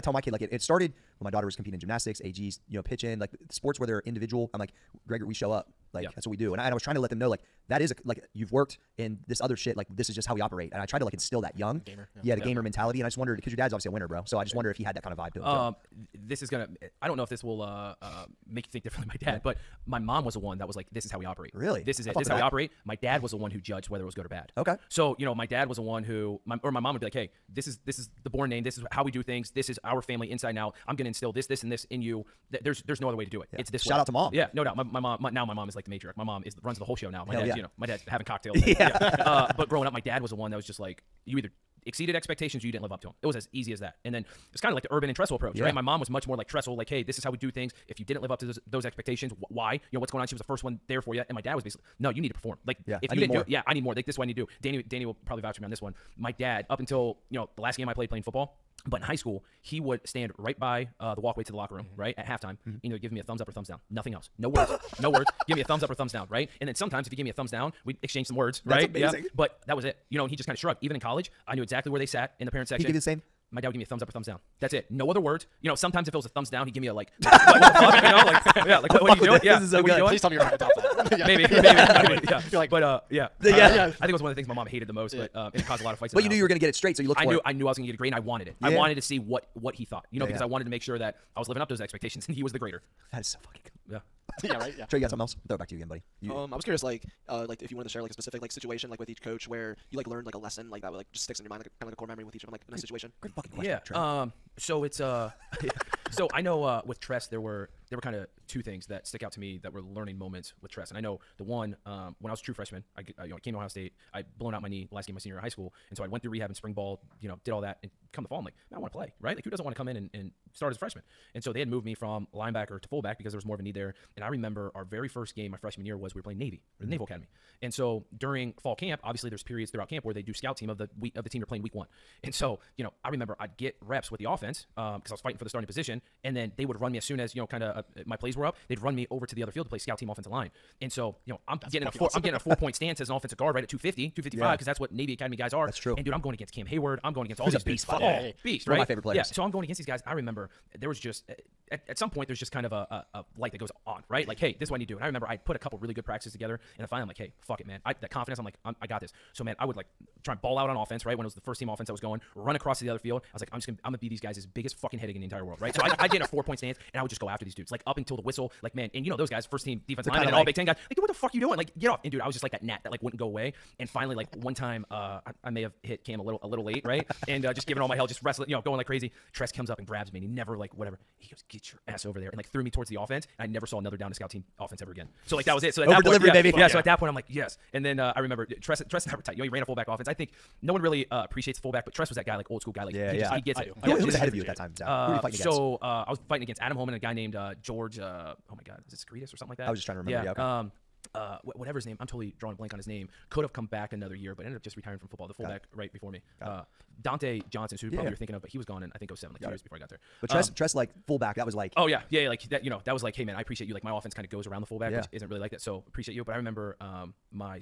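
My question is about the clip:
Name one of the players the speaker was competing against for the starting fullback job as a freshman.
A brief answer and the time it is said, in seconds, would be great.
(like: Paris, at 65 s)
Adam Homan, at 196 s.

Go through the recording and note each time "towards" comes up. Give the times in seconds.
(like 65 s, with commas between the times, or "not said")
182 s.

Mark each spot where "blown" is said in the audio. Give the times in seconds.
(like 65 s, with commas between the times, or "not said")
114 s.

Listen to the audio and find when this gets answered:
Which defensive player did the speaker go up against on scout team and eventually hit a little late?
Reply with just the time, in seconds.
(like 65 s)
146 s.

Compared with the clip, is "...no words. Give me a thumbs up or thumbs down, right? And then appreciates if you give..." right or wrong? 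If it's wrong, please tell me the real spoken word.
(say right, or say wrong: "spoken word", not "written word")
wrong: "sometimes", not "appreciates".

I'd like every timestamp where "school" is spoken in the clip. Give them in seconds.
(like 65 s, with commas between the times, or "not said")
59 s, 115 s, 192 s.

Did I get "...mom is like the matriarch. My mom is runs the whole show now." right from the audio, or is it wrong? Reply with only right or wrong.
right.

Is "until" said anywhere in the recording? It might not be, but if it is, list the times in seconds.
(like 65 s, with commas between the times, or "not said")
56 s, 167 s.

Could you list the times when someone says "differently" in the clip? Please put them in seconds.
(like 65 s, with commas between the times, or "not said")
18 s.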